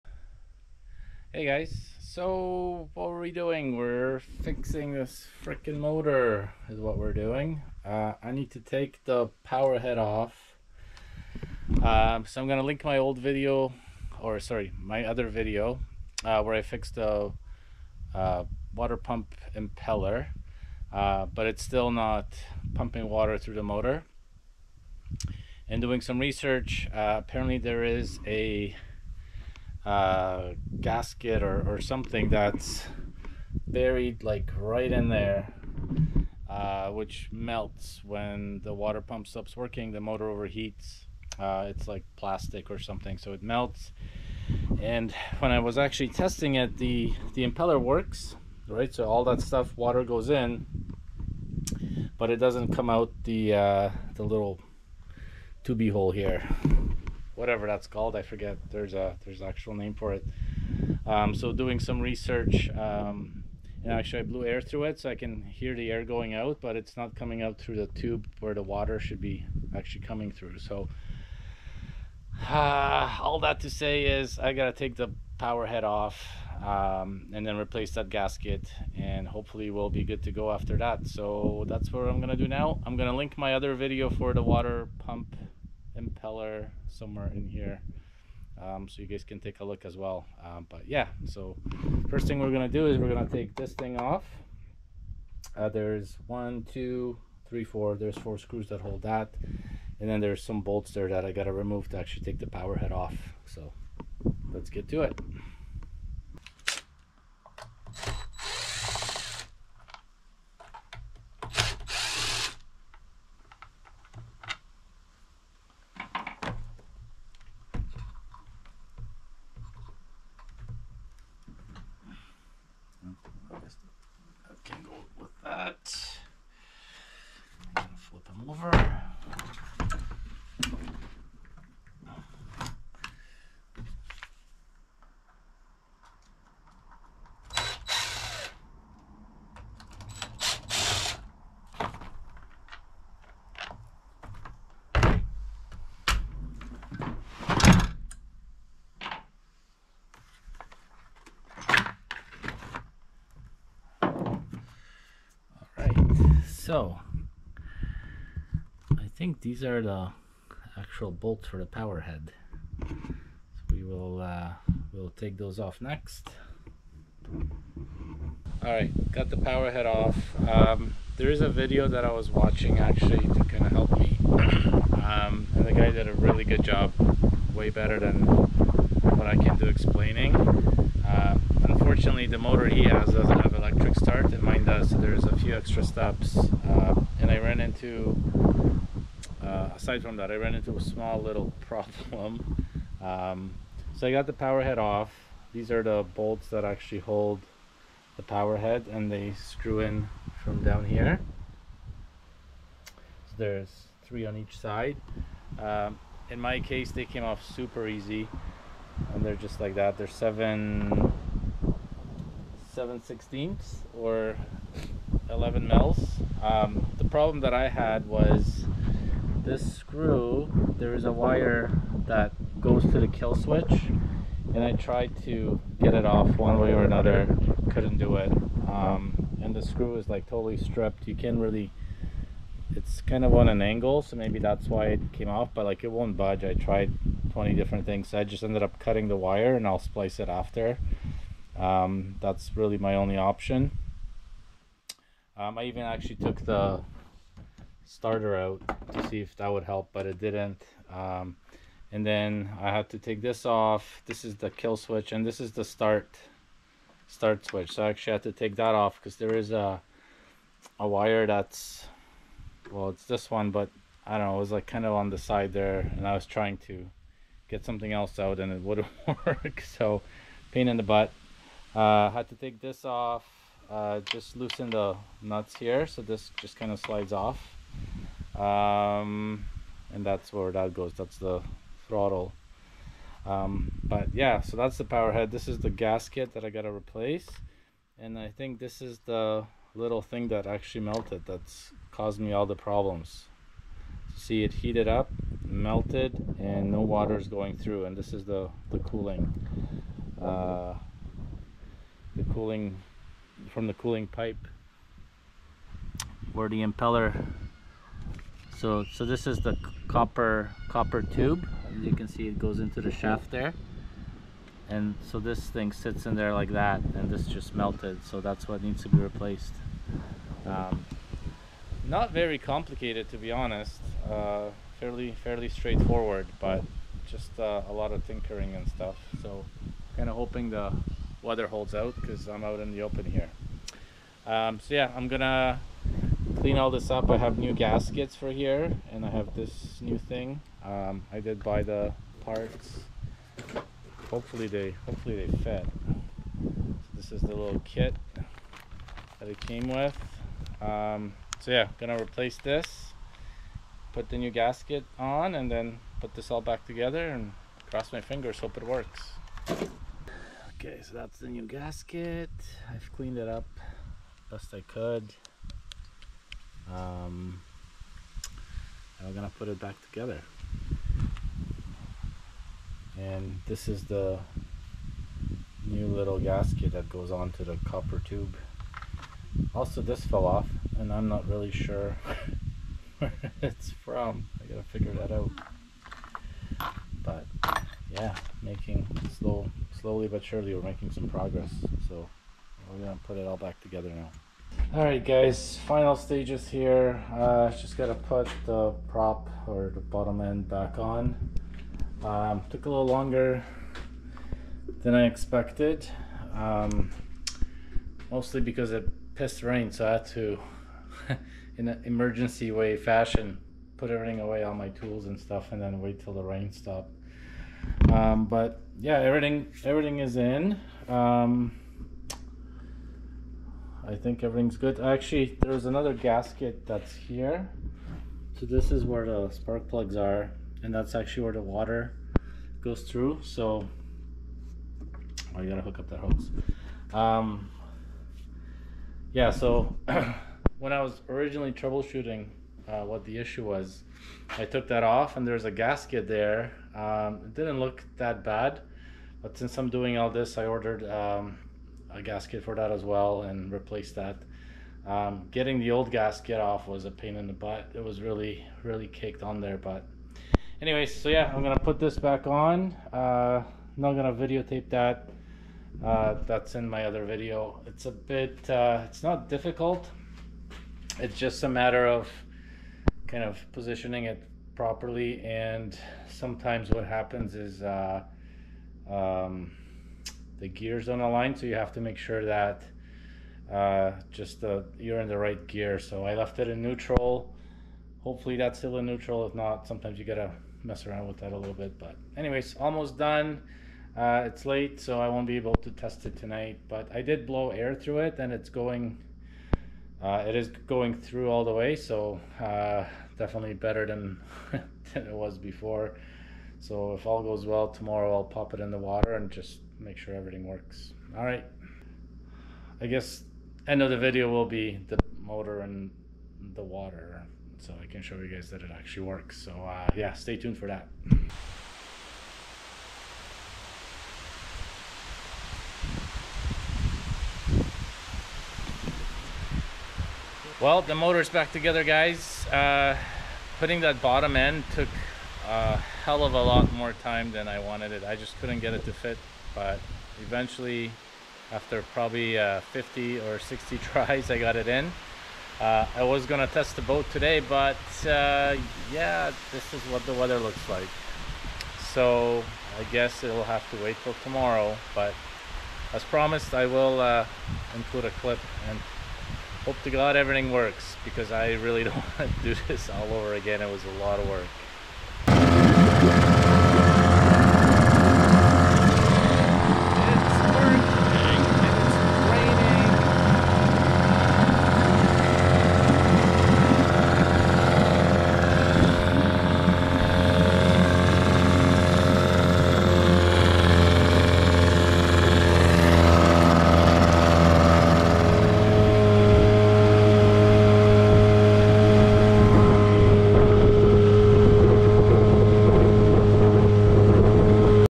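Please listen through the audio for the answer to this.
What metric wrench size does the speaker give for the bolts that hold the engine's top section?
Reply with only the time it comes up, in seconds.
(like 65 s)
215 s.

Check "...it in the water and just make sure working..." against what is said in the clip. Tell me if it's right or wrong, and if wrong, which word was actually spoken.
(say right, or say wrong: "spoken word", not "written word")
wrong: "everything", not "working".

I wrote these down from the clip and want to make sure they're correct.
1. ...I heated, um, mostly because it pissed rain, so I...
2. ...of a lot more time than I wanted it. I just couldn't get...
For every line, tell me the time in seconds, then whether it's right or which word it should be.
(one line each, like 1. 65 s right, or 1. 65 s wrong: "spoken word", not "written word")
1. 404 s wrong: "expected", not "heated"
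2. 536 s right.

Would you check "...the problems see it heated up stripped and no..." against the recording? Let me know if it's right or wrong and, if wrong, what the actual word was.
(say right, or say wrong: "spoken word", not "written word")
wrong: "melted", not "stripped".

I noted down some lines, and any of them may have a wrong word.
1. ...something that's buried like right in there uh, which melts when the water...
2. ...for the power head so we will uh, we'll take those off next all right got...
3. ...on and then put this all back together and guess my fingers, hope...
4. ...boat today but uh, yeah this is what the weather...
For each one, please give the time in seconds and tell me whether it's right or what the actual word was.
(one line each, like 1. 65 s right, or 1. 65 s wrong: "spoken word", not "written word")
1. 31 s right
2. 161 s right
3. 354 s wrong: "cross", not "guess"
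4. 546 s right.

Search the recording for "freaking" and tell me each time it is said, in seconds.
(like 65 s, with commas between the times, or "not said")
5 s.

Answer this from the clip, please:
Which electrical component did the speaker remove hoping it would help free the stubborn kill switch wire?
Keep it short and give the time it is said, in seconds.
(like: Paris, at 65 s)
starter, at 247 s.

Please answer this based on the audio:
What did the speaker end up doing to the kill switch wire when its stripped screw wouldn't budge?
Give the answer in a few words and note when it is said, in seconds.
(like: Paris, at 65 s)
cutting the wire, at 238 s.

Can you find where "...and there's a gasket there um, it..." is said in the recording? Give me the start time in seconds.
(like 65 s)
445 s.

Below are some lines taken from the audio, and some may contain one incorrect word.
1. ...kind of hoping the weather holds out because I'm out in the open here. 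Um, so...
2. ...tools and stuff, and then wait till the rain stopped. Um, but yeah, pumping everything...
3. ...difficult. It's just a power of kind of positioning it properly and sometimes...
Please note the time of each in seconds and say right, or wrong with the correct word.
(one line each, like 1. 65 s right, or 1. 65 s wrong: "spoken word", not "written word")
1. 329 s right
2. 414 s wrong: "everything", not "pumping"
3. 469 s wrong: "matter", not "power".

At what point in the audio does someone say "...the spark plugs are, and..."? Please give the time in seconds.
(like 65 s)
429 s.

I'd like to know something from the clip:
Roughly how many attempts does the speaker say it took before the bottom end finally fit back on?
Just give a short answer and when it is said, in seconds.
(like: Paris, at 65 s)
50 or 60, at 542 s.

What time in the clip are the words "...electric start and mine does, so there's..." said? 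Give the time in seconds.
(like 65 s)
183 s.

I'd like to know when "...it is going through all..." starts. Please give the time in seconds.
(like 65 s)
500 s.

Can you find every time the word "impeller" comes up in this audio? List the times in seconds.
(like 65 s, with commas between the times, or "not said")
19 s, 47 s, 85 s, 306 s.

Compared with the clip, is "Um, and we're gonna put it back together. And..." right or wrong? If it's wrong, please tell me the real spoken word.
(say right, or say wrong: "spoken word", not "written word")
right.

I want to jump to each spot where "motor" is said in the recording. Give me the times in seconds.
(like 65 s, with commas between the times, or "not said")
5 s, 23 s, 39 s, 182 s, 515 s, 530 s.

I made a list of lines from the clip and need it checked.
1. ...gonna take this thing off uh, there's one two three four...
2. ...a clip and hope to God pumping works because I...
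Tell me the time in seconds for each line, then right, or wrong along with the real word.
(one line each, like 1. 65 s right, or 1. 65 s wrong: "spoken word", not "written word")
1. 93 s right
2. 558 s wrong: "everything", not "pumping".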